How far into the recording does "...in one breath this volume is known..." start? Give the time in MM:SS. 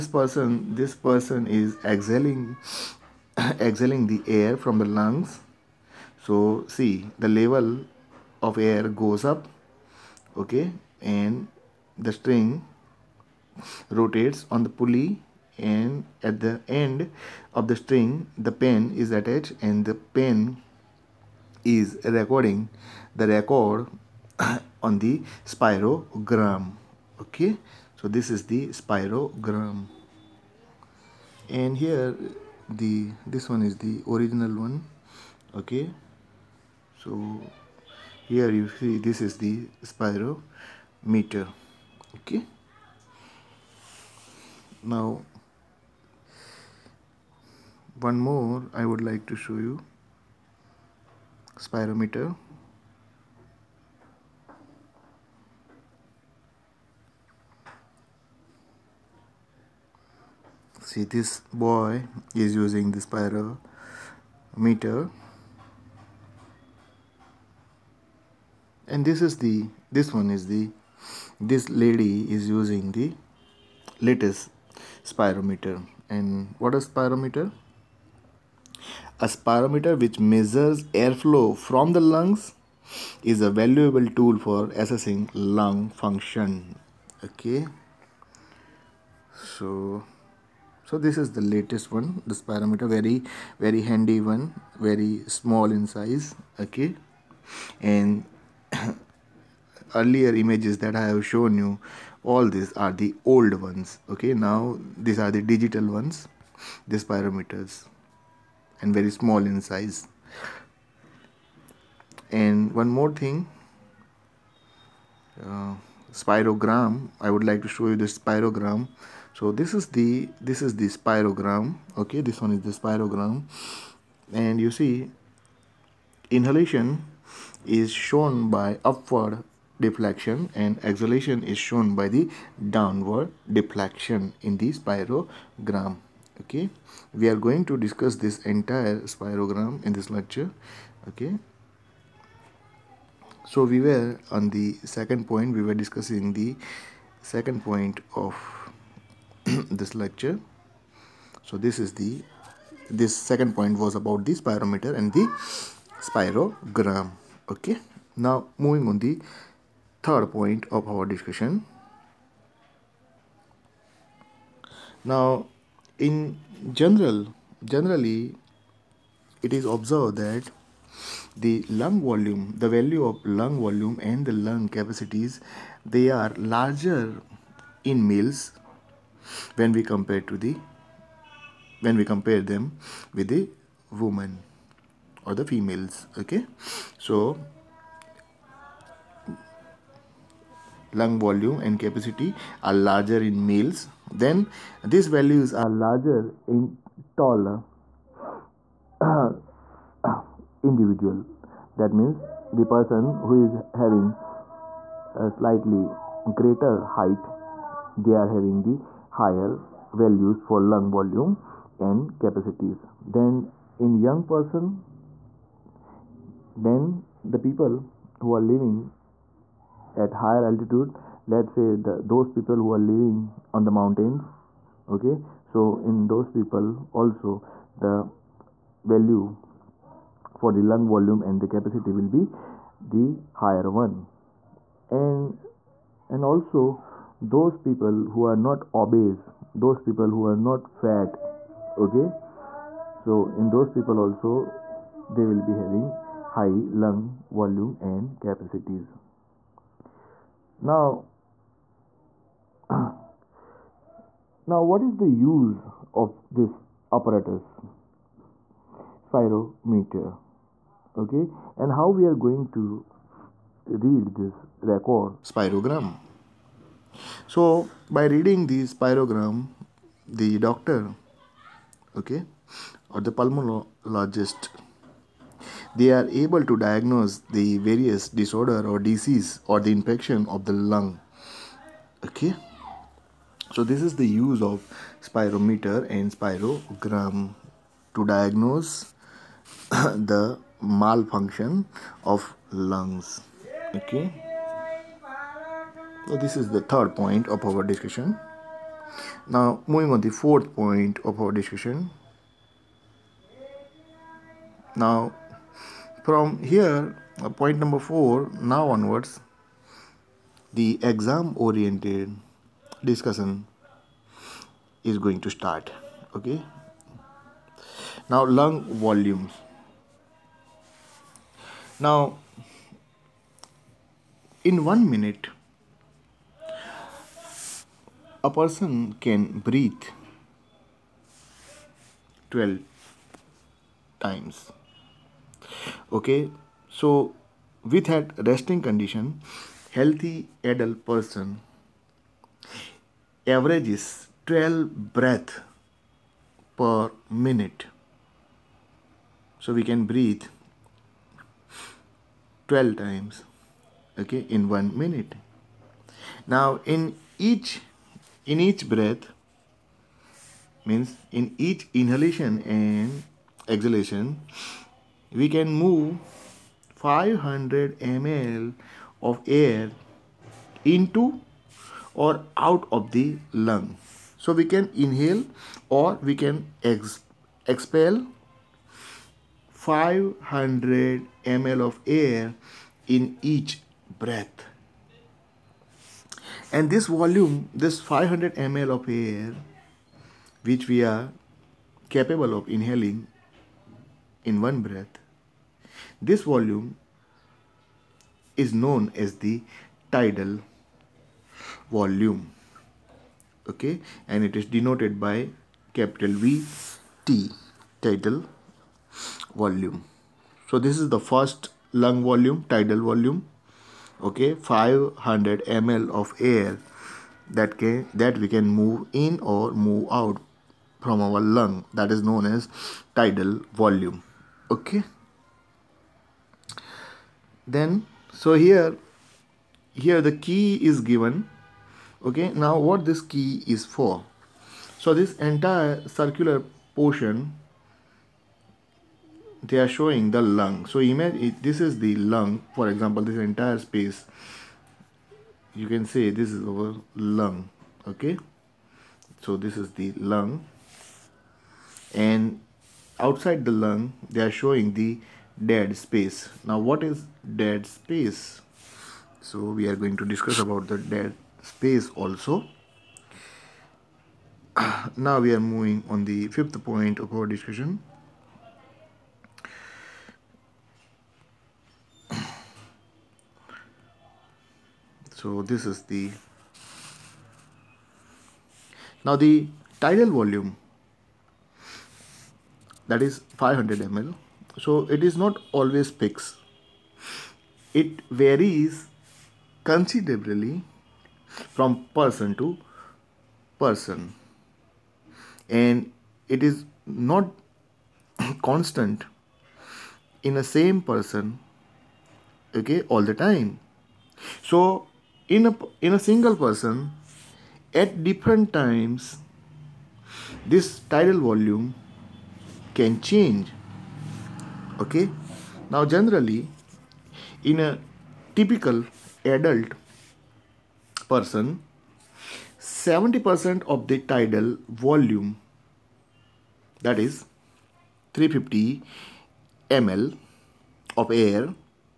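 06:34.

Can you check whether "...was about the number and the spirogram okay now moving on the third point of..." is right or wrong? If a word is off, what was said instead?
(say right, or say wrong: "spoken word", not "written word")
wrong: "spirometer", not "number".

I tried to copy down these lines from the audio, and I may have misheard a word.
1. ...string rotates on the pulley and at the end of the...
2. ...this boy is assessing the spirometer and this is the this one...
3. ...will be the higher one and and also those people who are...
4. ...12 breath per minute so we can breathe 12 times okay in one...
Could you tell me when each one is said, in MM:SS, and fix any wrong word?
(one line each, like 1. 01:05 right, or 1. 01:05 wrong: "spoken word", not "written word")
1. 00:12 right
2. 01:01 wrong: "using", not "assessing"
3. 03:51 right
4. 05:44 right.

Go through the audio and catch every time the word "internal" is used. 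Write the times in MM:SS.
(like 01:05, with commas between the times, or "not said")
not said.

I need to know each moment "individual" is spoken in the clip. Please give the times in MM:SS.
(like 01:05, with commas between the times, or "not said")
03:20.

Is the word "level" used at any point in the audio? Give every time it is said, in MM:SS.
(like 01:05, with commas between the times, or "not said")
00:07.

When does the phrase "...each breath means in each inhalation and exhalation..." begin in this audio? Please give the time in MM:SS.
05:58.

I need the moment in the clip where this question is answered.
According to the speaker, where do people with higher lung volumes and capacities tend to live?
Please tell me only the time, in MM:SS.
03:40.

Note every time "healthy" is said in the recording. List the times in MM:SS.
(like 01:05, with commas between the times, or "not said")
05:39.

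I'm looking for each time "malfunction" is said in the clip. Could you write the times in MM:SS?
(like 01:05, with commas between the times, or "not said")
04:50.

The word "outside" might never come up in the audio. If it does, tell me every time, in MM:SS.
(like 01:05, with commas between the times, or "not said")
07:32.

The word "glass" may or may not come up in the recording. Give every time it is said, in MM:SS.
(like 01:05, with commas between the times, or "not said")
not said.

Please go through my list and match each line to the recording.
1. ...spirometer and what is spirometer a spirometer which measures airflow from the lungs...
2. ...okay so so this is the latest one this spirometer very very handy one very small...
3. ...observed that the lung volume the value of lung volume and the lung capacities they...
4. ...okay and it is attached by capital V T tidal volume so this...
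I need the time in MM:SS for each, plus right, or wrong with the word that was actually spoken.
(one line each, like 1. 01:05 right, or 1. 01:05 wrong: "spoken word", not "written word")
1. 01:15 right
2. 01:27 right
3. 02:49 right
4. 06:43 wrong: "denoted", not "attached".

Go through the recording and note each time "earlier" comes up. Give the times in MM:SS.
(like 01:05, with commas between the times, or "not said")
01:39.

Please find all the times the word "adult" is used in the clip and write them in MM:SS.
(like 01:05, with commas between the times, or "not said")
05:40, 08:39.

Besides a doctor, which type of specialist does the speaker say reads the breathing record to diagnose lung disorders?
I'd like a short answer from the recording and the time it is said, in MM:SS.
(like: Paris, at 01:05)
pulmonologist, at 04:33.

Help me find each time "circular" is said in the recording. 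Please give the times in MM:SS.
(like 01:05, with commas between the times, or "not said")
07:15.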